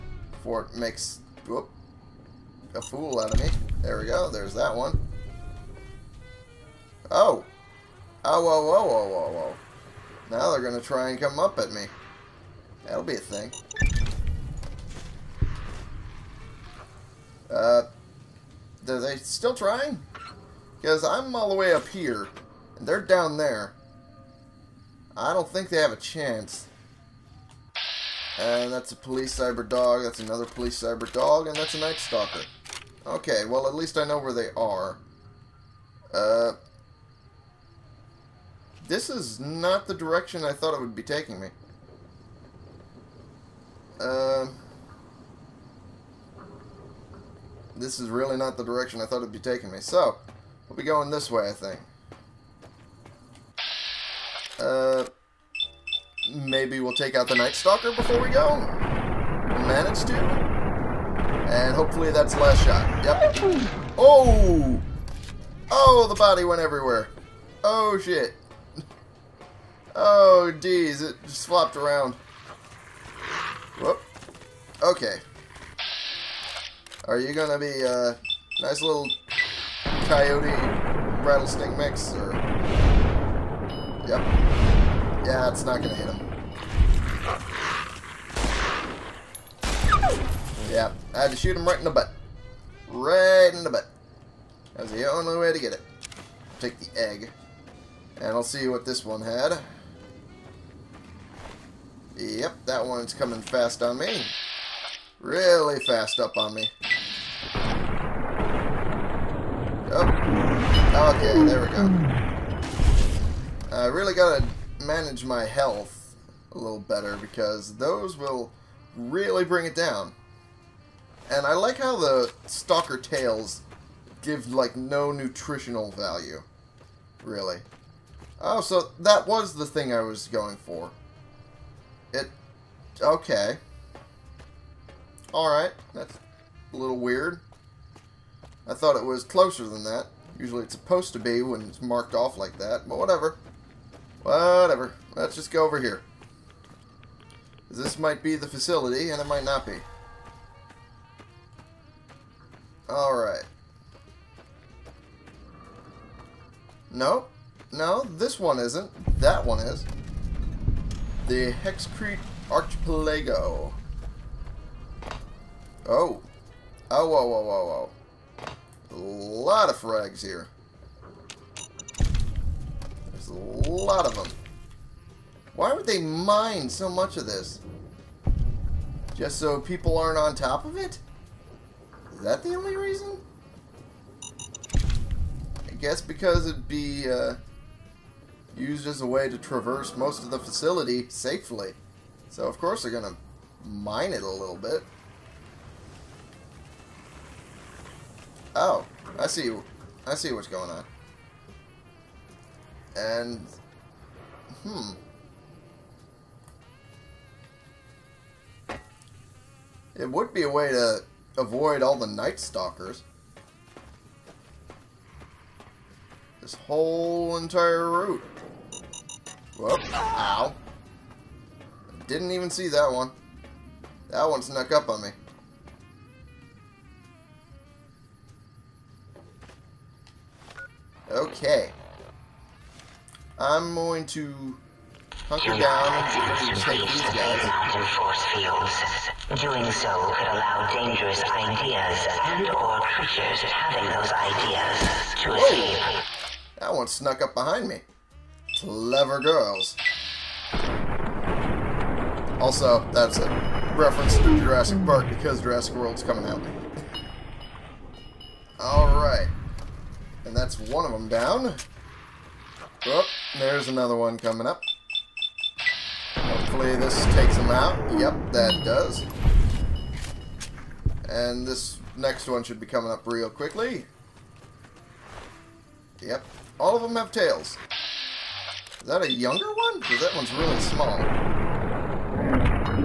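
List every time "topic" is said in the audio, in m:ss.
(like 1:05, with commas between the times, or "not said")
not said.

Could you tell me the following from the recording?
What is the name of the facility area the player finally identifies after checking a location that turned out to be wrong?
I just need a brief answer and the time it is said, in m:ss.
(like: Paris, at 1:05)
Hexcrete Archipelago, at 2:41.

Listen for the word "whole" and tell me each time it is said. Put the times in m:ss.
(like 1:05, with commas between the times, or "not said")
3:36.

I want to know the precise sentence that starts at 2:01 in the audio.
And I like how the stalker tails give, like, no nutritional value.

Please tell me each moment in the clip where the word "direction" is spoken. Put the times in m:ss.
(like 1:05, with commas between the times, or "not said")
0:39, 0:48.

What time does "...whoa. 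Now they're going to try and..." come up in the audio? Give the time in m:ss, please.
0:09.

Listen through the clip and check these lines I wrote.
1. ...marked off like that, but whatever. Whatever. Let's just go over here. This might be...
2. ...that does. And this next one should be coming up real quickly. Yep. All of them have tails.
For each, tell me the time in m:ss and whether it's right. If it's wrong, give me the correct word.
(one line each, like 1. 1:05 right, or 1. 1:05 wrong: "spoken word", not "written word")
1. 2:21 right
2. 4:28 right.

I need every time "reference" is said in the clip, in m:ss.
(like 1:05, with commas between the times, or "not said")
4:13.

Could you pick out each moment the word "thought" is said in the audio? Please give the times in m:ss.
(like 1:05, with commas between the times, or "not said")
0:40, 0:49, 2:18.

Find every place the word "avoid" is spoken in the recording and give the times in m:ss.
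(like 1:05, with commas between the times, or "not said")
3:31.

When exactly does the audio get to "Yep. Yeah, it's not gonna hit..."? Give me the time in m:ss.
1:24.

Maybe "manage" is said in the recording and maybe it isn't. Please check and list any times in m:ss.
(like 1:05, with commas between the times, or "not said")
0:59, 1:54.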